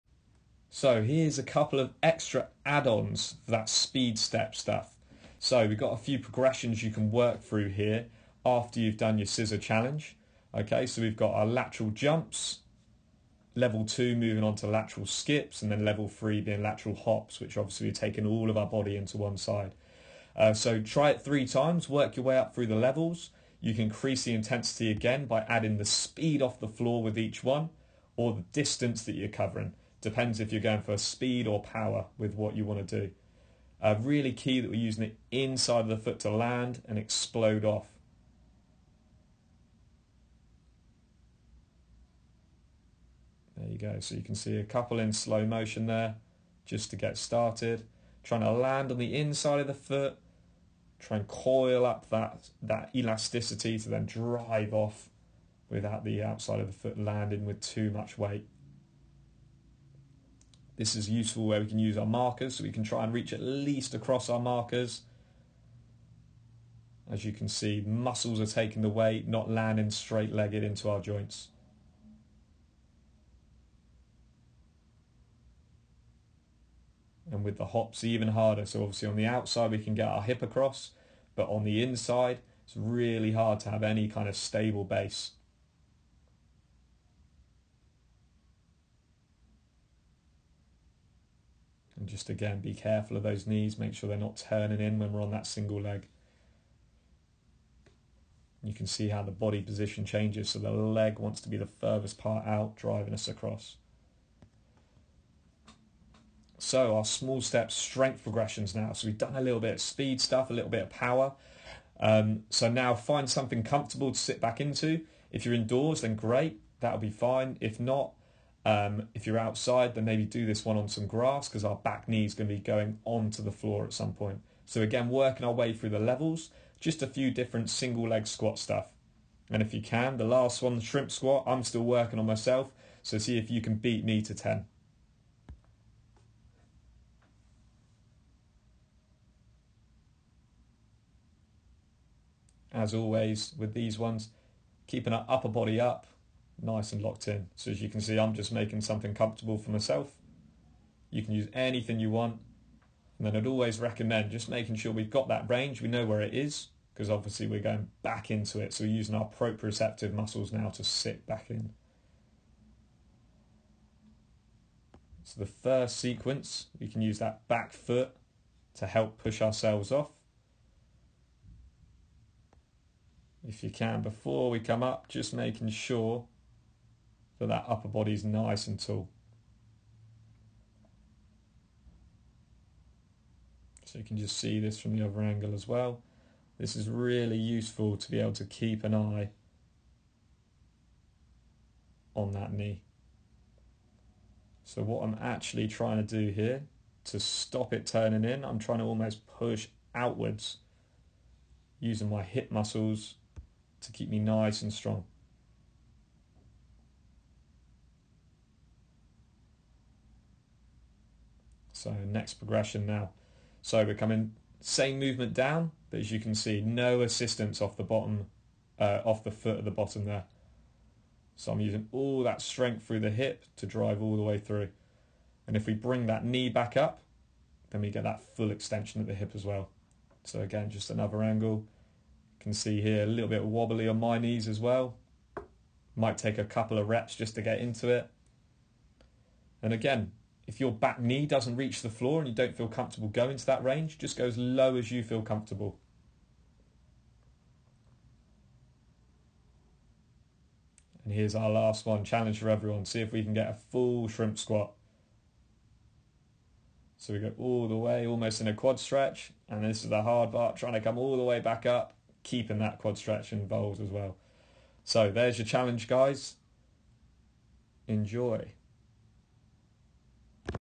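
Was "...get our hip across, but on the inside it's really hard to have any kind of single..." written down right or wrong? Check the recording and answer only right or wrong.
wrong.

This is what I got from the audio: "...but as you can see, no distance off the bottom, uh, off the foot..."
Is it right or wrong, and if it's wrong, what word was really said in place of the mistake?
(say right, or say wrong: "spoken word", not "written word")
wrong: "assistance", not "distance".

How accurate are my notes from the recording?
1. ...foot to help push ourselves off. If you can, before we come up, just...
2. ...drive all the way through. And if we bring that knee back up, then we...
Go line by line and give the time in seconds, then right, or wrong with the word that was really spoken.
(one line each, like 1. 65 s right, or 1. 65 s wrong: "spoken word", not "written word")
1. 167 s right
2. 223 s right.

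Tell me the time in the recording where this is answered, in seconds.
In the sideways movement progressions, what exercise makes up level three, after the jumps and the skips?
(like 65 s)
16 s.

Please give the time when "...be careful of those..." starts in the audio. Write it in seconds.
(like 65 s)
92 s.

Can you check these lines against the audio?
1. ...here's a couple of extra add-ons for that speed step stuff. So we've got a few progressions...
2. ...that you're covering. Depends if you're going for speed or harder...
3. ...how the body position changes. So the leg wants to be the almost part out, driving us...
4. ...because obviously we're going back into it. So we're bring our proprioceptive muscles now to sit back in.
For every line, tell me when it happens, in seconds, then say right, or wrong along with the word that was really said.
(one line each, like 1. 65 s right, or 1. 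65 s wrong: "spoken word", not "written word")
1. 1 s right
2. 29 s wrong: "power", not "harder"
3. 99 s wrong: "furthest", not "almost"
4. 156 s wrong: "using", not "bring".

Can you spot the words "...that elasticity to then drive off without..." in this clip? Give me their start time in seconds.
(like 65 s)
52 s.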